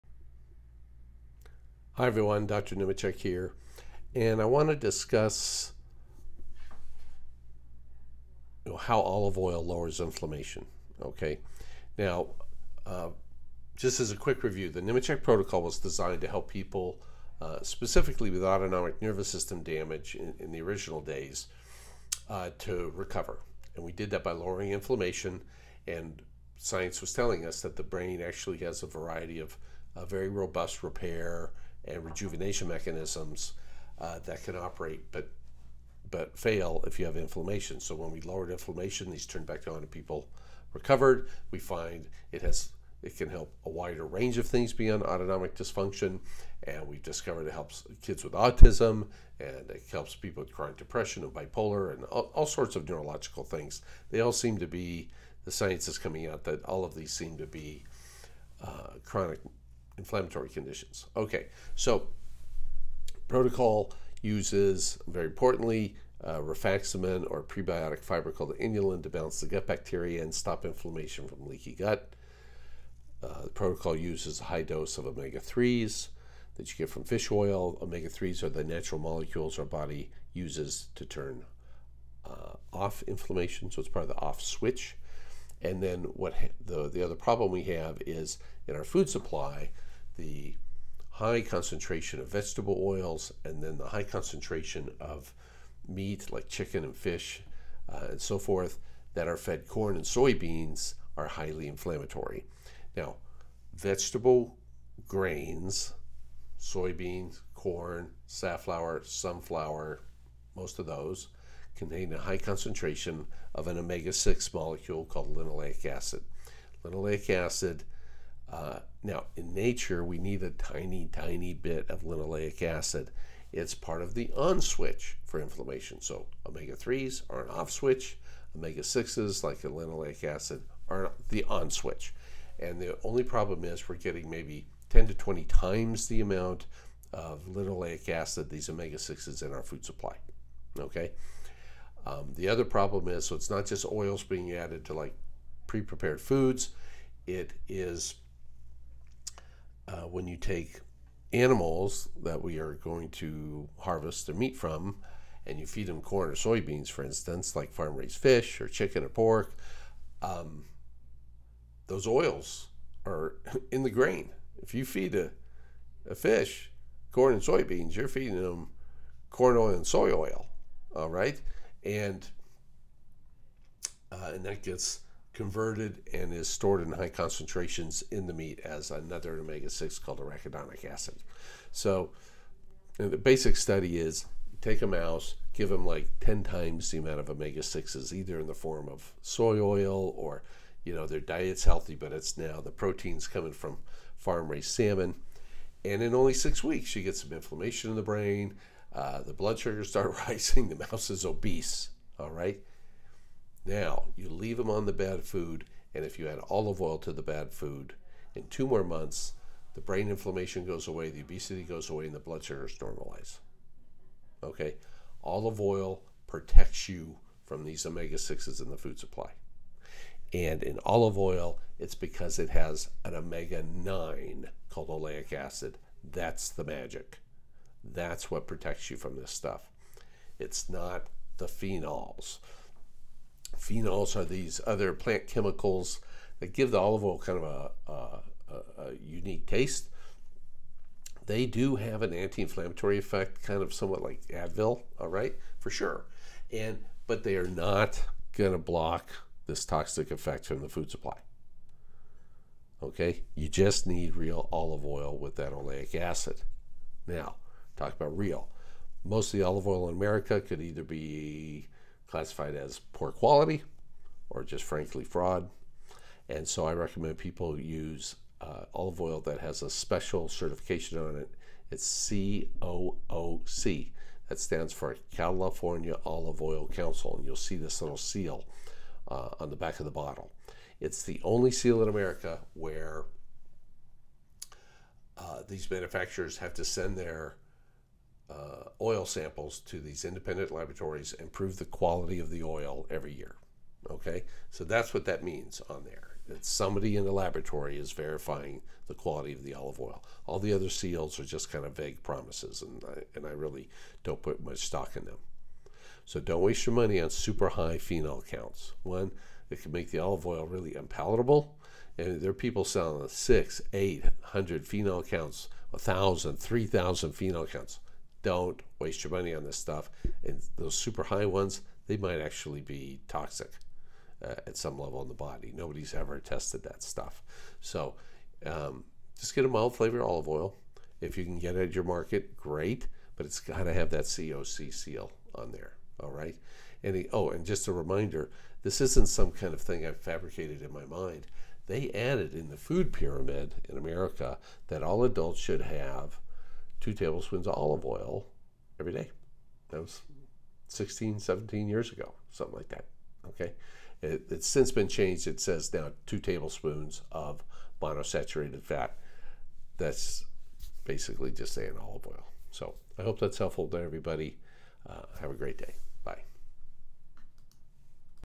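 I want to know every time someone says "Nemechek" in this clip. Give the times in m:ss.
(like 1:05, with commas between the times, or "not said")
0:02, 0:14.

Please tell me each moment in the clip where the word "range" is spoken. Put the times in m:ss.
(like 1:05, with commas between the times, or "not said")
0:44.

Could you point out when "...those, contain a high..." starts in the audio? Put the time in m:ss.
1:50.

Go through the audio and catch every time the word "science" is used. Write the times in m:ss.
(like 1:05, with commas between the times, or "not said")
0:26, 0:55.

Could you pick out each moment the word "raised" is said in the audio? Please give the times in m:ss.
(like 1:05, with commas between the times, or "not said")
2:37, 3:14.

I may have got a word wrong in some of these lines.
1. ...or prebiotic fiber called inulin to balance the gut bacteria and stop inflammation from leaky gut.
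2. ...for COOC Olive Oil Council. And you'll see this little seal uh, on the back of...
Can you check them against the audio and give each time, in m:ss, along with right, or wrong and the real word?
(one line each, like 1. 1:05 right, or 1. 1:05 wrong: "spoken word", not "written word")
1. 1:07 right
2. 4:34 wrong: "California", not "COOC".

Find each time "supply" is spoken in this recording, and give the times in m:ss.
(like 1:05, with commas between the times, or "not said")
1:29, 2:19, 3:38, 4:10.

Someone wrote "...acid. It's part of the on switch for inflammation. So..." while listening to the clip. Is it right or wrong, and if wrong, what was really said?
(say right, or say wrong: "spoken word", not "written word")
right.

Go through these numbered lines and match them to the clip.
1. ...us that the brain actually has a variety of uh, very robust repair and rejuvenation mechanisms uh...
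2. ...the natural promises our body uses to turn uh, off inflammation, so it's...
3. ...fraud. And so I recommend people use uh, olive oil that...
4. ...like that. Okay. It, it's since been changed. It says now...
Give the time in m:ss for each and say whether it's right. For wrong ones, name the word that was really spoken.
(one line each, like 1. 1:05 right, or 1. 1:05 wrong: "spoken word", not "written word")
1. 0:27 right
2. 1:18 wrong: "molecules", not "promises"
3. 4:25 right
4. 5:52 right.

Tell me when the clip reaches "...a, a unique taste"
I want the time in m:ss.
3:57.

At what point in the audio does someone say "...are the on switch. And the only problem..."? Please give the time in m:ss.
2:10.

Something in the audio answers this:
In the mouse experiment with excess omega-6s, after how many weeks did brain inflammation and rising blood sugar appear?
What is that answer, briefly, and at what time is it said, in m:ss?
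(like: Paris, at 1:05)
6 weeks, at 3:16.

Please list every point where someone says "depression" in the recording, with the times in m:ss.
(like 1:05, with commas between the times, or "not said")
0:50.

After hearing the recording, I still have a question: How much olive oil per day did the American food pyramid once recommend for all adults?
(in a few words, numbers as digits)
2 tablespoons.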